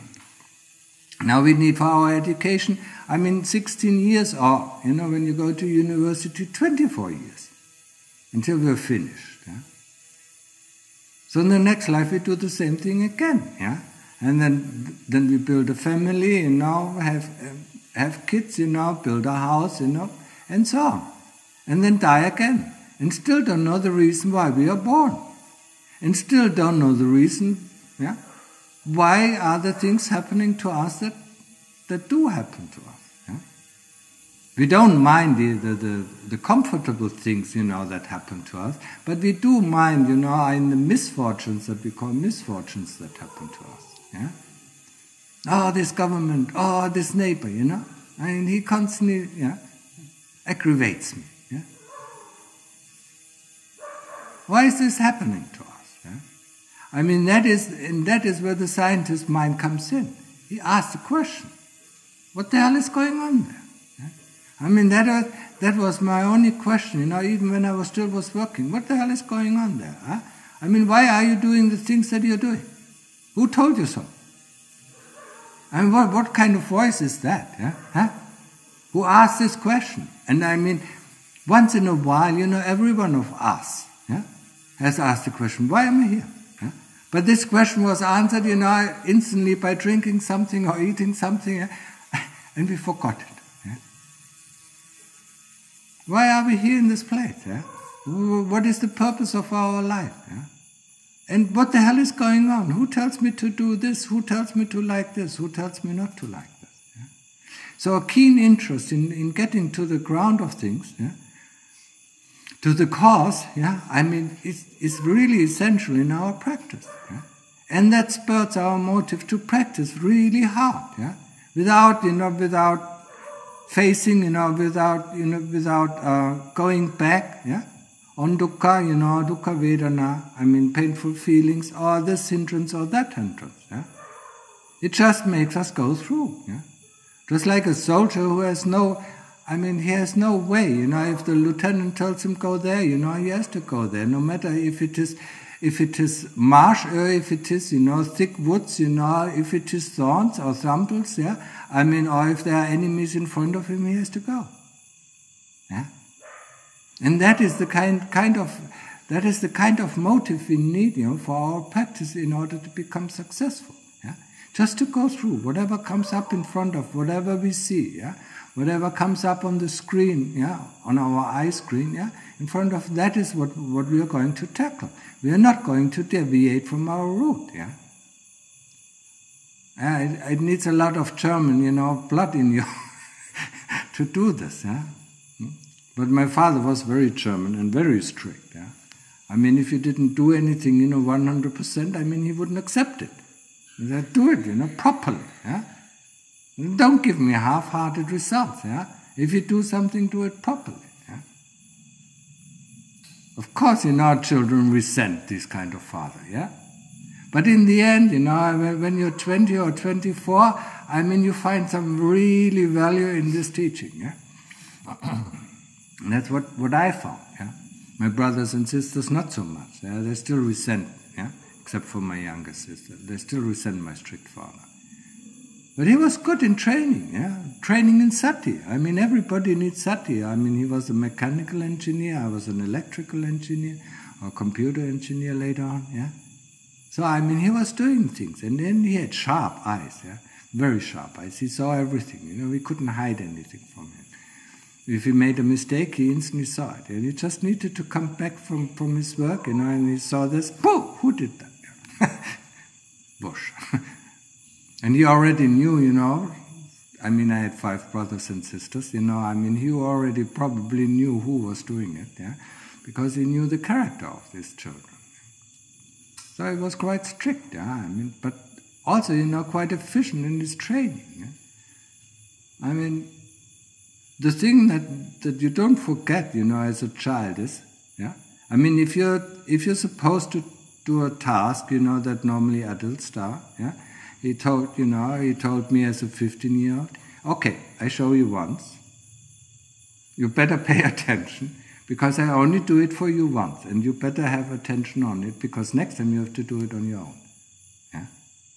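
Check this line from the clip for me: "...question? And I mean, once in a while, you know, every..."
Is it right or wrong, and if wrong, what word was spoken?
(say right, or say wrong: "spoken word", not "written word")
right.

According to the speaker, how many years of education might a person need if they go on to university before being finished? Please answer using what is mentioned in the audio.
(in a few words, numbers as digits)
24.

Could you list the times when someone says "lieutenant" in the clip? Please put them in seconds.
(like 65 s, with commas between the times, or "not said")
141 s.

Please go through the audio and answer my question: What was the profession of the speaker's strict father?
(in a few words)
mechanical engineer.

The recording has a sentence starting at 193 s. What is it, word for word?
He said, do it, you know, properly.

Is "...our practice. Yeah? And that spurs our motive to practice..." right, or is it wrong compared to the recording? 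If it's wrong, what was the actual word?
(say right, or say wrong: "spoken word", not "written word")
right.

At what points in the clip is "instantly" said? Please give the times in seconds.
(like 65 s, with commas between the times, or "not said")
89 s, 246 s.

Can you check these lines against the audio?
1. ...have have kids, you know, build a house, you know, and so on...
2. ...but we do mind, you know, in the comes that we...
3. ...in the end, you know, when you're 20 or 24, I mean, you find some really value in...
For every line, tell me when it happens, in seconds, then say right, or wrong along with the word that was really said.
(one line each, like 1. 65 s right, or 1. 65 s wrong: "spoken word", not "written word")
1. 16 s right
2. 39 s wrong: "misfortunes", not "comes"
3. 207 s right.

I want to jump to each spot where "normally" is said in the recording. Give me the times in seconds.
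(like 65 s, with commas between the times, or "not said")
282 s.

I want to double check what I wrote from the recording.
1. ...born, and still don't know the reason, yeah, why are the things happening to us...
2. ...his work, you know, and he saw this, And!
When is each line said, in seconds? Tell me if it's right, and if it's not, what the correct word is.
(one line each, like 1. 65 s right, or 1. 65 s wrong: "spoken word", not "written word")
1. 24 s right
2. 248 s wrong: "Pooh", not "And".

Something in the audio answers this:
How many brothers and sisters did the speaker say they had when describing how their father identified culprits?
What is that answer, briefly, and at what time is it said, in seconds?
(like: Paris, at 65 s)
5, at 257 s.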